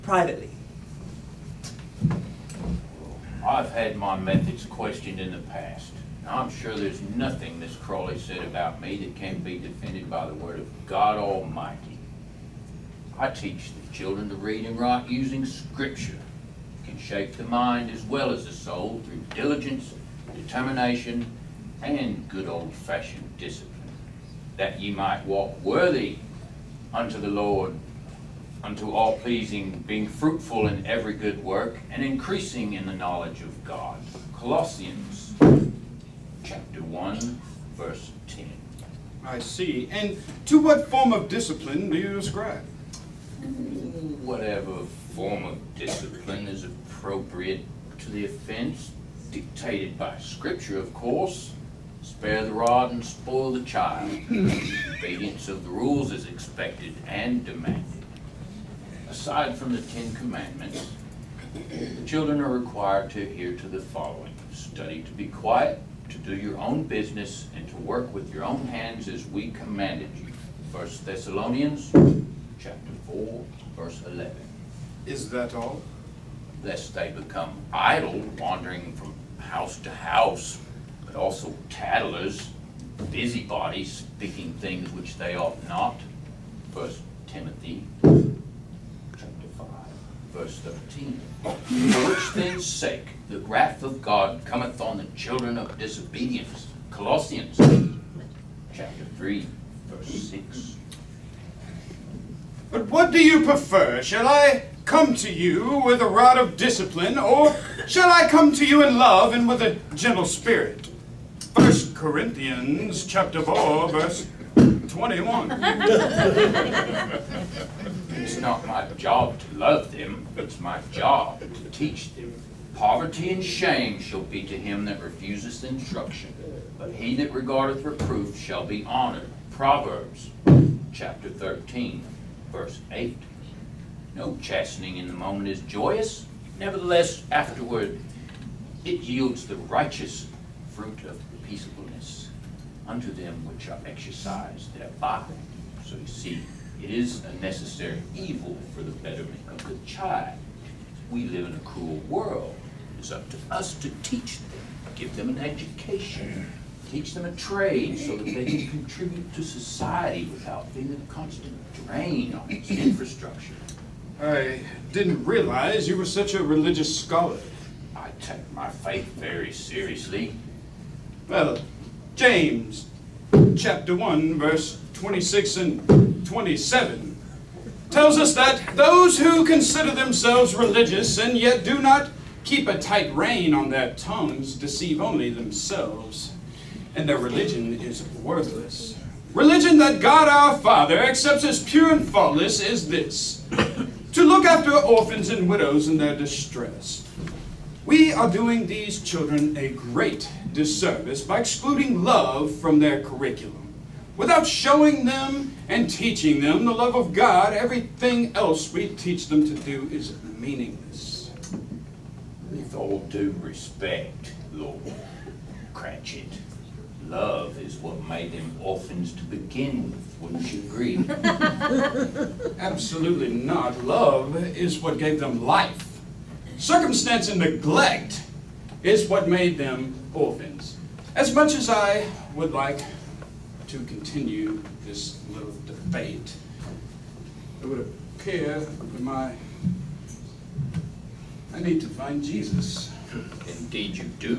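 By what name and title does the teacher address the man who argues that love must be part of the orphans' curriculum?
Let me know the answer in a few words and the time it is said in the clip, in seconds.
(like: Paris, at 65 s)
Lord Cratchit, at 214 s.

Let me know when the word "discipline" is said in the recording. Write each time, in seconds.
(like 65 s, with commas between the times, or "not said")
23 s, 41 s, 45 s, 106 s.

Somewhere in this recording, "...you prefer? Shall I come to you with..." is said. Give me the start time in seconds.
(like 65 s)
103 s.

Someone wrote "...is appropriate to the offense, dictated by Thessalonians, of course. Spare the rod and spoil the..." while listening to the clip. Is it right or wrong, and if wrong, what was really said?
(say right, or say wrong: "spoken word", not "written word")
wrong: "Scripture", not "Thessalonians".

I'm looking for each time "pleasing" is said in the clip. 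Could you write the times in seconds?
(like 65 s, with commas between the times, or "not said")
29 s.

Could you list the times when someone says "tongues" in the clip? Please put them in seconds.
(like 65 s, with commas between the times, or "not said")
183 s.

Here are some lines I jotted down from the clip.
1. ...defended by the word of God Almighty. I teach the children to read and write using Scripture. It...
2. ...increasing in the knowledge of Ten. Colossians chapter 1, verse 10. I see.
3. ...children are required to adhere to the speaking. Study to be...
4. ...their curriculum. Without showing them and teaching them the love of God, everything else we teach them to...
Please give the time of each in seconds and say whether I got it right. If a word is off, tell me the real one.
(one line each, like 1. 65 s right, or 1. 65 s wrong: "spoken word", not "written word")
1. 9 s right
2. 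32 s wrong: "God", not "Ten"
3. 62 s wrong: "following", not "speaking"
4. 202 s right.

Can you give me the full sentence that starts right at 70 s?
1 Thessalonians chapter 4, verse 11.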